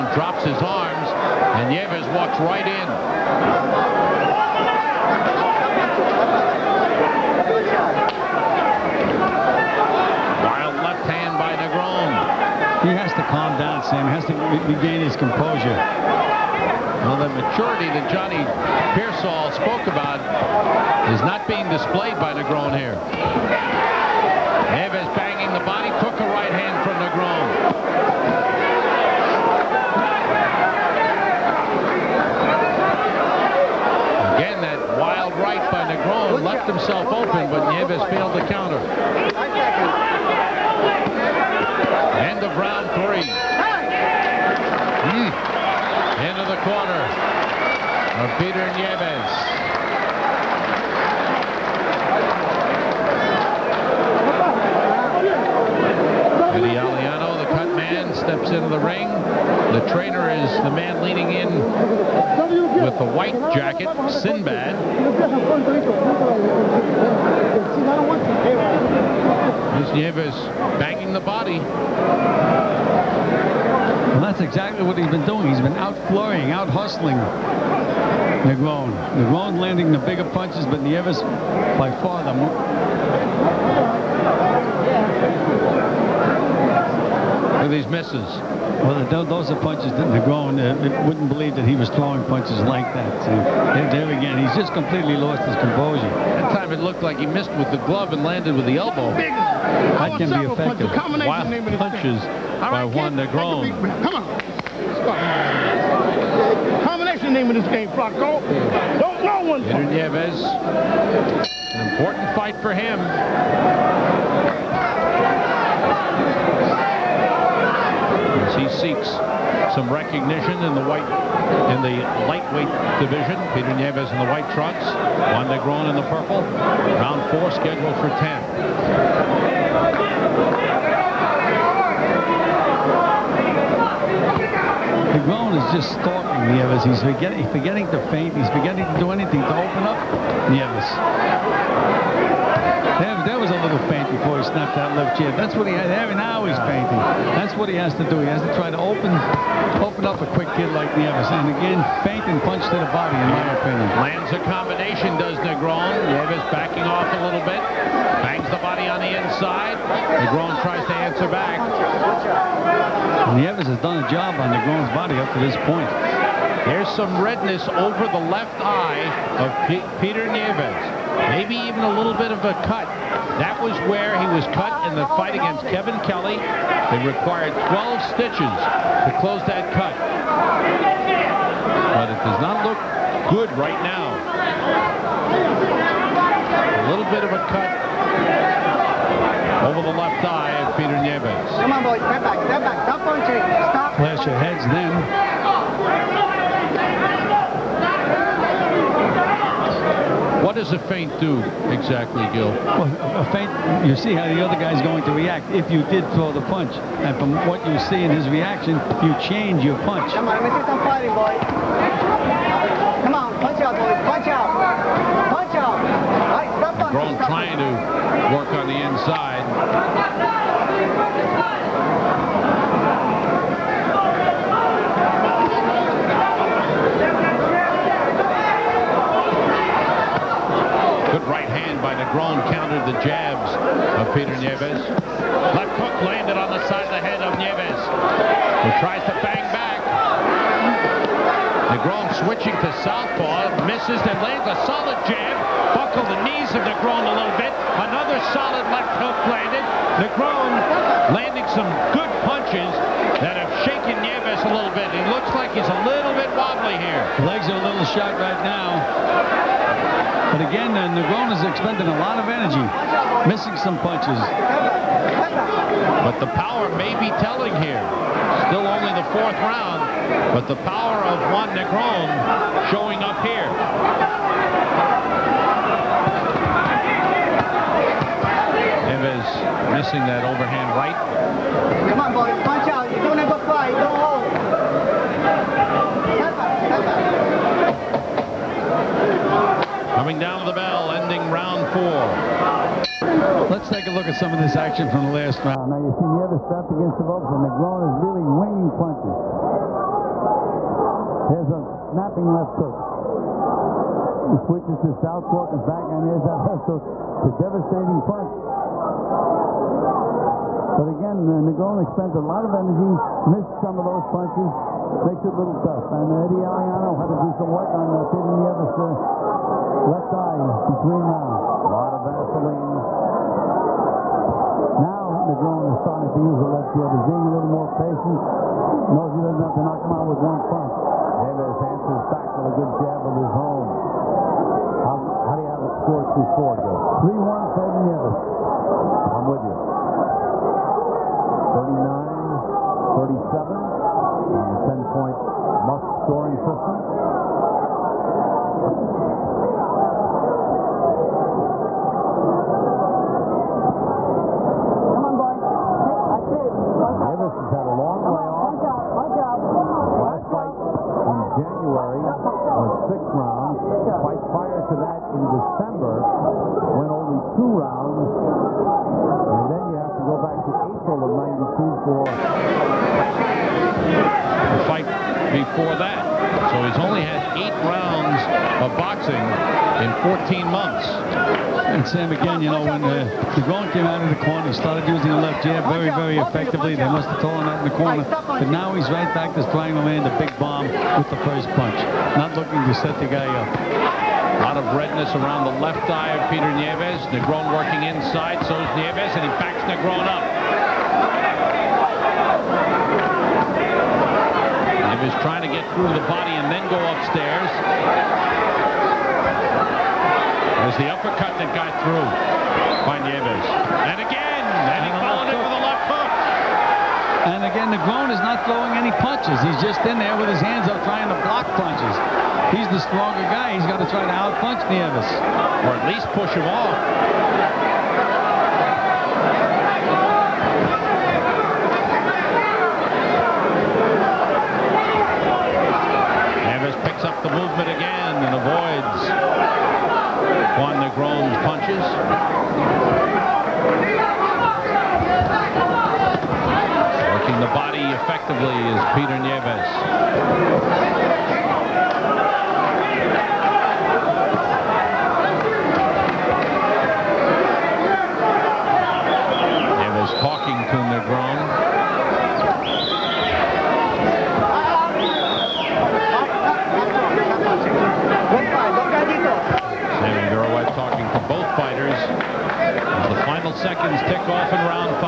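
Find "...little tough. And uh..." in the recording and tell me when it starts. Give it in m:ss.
5:15.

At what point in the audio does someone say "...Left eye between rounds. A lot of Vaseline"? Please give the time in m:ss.
5:19.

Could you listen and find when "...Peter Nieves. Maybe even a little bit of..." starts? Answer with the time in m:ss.
2:49.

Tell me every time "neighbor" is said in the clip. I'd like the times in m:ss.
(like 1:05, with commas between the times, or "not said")
not said.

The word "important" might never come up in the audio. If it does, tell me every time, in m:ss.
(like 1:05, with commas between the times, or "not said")
1:51.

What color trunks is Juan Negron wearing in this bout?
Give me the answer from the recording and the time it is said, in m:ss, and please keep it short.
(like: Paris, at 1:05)
Purple, at 2:06.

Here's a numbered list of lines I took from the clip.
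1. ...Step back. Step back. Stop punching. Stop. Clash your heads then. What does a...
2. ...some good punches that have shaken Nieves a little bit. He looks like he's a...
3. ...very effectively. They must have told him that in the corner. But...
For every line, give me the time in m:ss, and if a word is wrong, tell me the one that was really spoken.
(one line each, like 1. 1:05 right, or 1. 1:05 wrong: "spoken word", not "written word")
1. 3:11 right
2. 4:11 right
3. 6:25 right.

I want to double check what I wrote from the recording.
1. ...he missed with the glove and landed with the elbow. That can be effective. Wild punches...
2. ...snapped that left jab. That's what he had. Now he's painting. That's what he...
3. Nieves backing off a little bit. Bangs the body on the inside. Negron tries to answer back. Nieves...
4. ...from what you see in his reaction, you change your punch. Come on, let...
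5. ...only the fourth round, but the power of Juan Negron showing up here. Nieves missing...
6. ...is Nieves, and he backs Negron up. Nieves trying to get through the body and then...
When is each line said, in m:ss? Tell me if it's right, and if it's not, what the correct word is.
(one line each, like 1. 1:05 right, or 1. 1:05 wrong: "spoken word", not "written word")
1. 1:37 right
2. 2:24 right
3. 2:36 right
4. 3:27 right
5. 4:28 right
6. 6:38 right.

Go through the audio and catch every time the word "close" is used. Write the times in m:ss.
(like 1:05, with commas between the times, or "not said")
2:59.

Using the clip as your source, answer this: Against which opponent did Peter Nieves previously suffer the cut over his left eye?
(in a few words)
Kevin Kelly.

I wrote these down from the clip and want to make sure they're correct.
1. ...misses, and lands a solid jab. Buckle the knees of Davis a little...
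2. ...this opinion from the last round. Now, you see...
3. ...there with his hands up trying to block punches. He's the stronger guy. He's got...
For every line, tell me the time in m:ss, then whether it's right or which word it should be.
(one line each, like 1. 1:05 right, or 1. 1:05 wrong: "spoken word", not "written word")
1. 4:03 wrong: "Negron", not "Davis"
2. 4:54 wrong: "action", not "opinion"
3. 6:59 right.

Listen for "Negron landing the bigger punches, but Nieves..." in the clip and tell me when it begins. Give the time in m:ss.
1:19.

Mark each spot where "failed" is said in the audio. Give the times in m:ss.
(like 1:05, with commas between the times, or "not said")
0:38.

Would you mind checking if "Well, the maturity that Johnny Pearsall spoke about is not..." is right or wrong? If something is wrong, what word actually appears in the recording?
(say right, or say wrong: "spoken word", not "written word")
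right.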